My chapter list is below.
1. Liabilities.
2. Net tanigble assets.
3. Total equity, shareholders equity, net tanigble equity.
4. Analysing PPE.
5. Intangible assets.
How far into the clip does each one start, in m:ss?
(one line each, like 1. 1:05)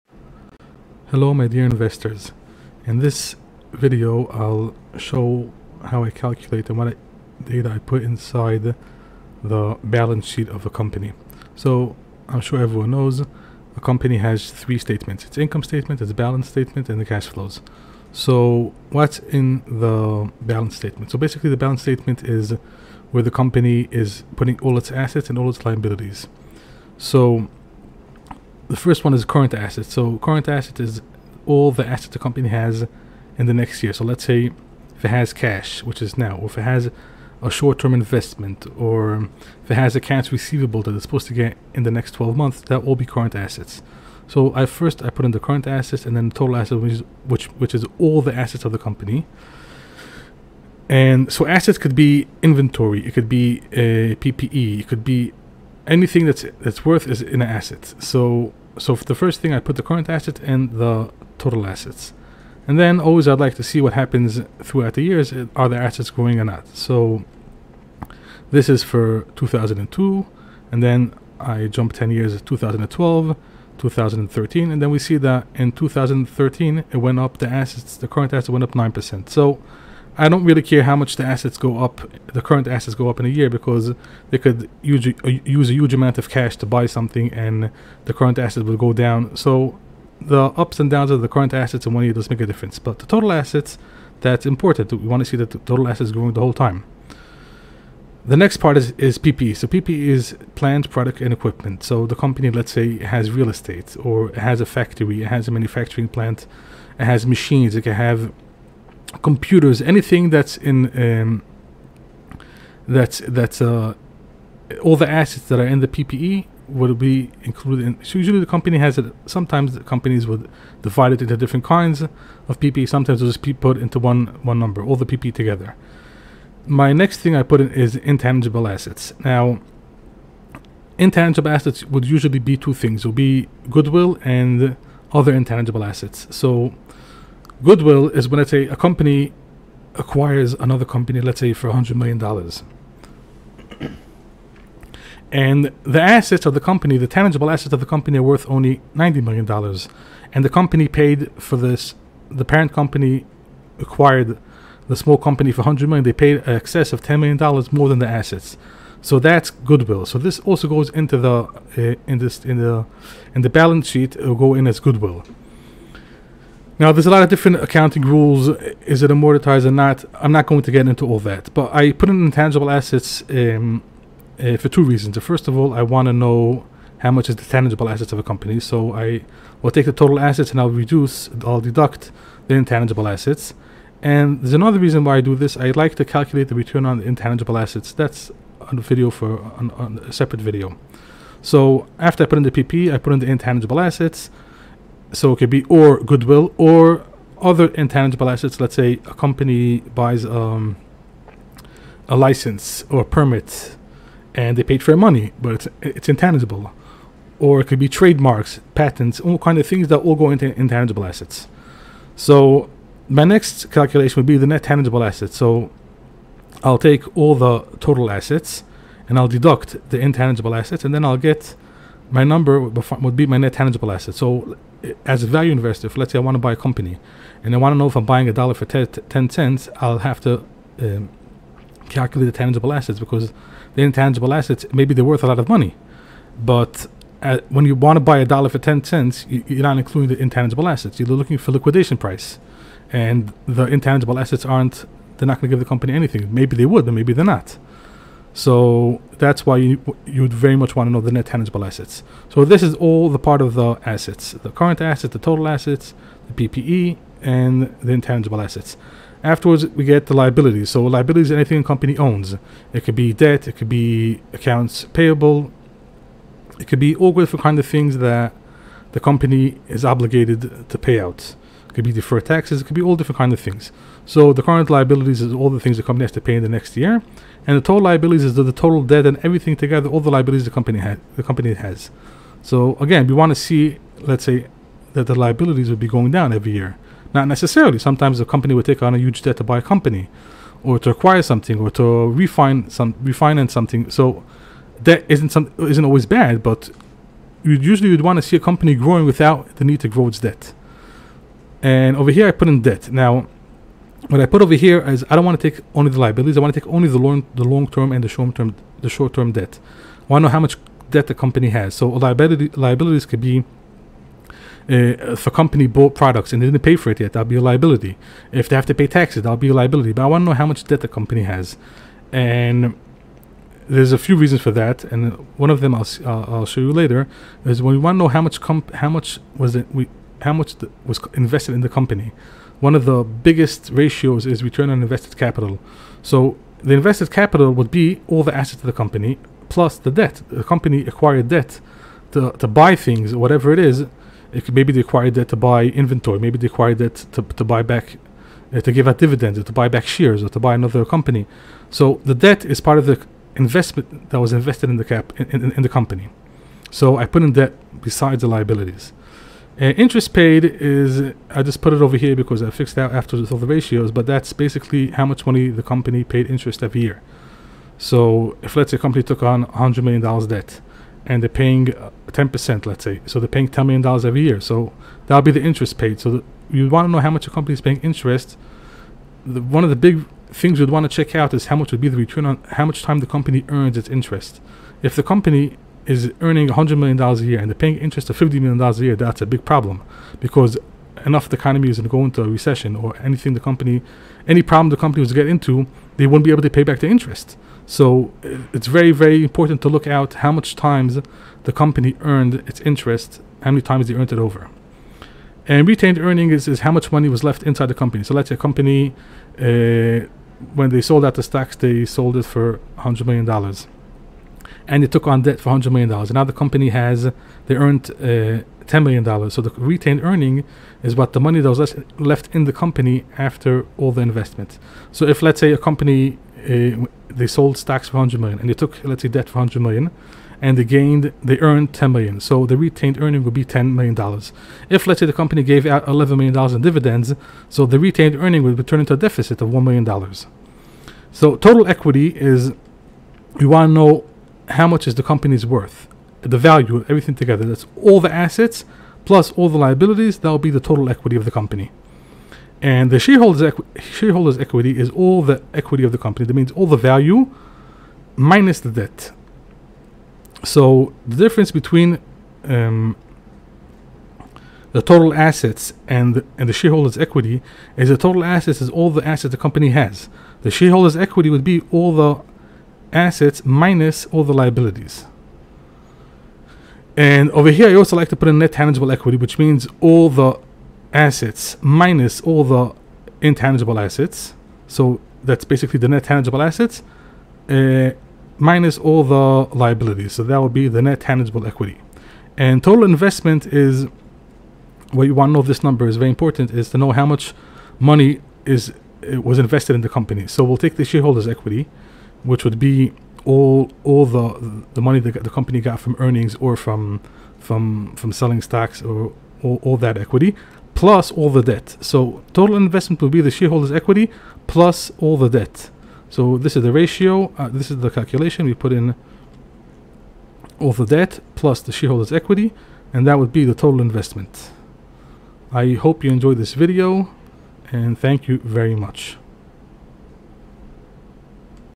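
1. 4:19
2. 3:35
3. 7:20
4. 1:38
5. 2:06.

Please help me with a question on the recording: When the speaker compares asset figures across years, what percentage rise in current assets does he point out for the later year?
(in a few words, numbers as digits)
9%.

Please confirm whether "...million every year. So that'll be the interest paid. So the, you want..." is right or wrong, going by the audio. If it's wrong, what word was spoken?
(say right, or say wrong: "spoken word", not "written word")
right.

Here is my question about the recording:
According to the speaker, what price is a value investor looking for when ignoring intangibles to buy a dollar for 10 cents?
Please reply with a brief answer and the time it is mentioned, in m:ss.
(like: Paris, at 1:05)
liquidation price, at 4:01.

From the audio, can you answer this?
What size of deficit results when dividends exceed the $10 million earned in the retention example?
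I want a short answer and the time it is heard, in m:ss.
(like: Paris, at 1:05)
$1 million, at 7:19.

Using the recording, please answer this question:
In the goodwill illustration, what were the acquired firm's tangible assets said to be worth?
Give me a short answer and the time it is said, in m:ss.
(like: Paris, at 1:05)
$90 million, at 2:28.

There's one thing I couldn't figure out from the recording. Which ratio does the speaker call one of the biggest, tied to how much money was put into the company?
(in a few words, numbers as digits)
return on invested capital.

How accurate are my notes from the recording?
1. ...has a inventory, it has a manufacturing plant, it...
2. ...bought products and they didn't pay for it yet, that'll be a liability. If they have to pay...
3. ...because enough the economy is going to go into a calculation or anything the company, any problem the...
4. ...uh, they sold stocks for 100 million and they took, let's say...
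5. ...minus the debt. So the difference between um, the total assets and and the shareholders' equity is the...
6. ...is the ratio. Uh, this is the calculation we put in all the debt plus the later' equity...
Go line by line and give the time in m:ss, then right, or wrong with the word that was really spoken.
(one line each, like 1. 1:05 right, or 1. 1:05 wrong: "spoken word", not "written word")
1. 1:44 wrong: "factory", not "inventory"
2. 5:15 right
3. 6:30 wrong: "recession", not "calculation"
4. 7:06 right
5. 7:38 right
6. 8:36 wrong: "shareholders", not "later".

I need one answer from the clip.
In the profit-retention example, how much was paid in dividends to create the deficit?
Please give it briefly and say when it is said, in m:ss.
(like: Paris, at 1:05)
$11 million, at 7:15.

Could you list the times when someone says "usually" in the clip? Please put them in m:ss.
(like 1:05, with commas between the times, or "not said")
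1:58, 2:12, 4:57.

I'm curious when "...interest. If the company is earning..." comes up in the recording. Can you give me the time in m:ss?
6:23.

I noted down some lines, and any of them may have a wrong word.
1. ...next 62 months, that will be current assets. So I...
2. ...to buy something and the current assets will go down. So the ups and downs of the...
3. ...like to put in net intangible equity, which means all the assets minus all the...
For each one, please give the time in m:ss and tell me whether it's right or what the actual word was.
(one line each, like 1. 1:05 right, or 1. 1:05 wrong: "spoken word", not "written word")
1. 0:41 wrong: "12", not "62"
2. 1:26 right
3. 7:57 wrong: "tangible", not "intangible".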